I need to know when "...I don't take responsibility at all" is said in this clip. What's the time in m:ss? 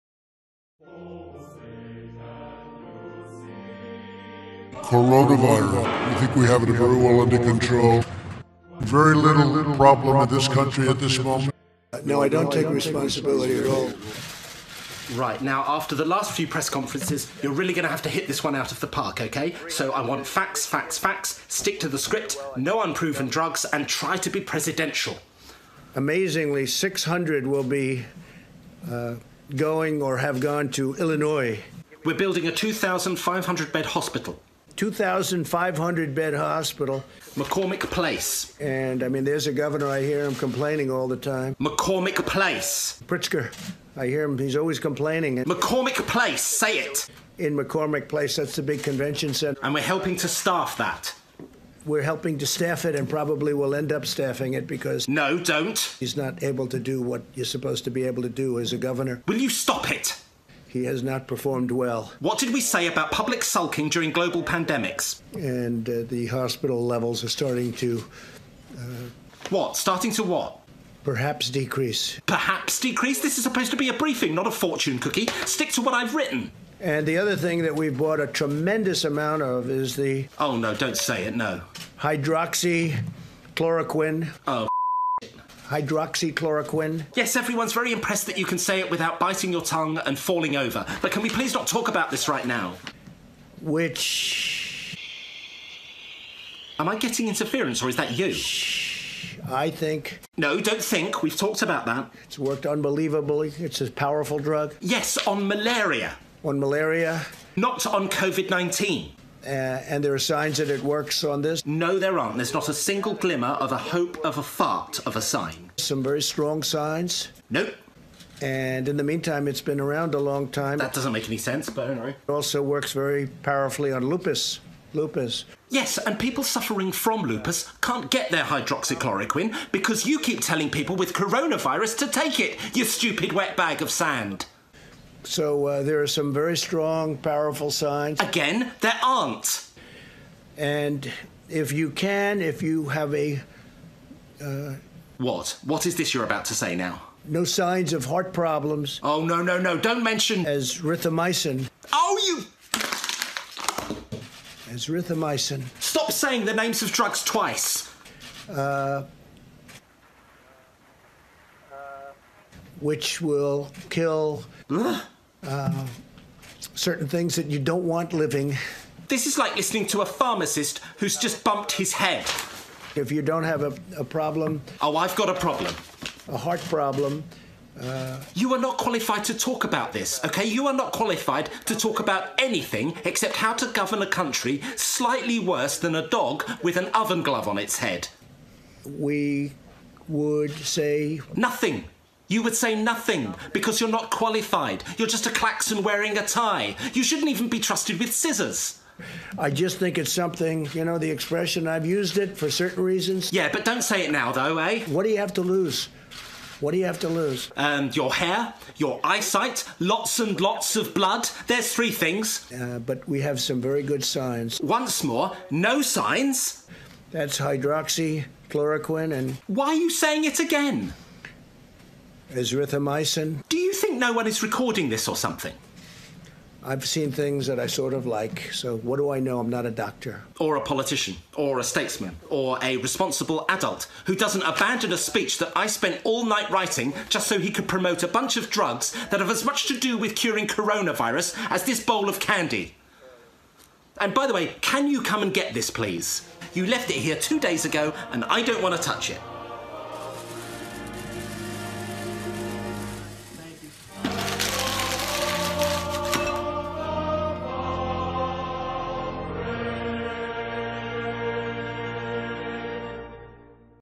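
0:12.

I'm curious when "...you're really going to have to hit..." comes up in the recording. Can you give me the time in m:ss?
0:17.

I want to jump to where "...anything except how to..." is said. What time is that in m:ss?
3:02.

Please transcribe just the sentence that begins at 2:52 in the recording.
If you don't have a, a problem, Oh, I've got a problem.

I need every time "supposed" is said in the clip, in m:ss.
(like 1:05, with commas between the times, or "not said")
0:57, 1:13.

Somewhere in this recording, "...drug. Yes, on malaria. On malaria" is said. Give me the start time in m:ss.
1:44.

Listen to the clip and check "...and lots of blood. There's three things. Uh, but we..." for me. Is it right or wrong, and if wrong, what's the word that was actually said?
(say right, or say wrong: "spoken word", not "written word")
right.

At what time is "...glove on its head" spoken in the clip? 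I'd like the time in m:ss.
3:07.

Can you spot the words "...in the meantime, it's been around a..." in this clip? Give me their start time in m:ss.
1:58.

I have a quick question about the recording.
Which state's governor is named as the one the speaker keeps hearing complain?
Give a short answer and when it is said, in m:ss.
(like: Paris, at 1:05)
Pritzker, at 0:43.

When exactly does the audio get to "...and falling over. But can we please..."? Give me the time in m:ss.
1:30.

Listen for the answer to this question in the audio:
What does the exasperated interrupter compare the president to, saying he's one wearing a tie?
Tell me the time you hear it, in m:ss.
3:15.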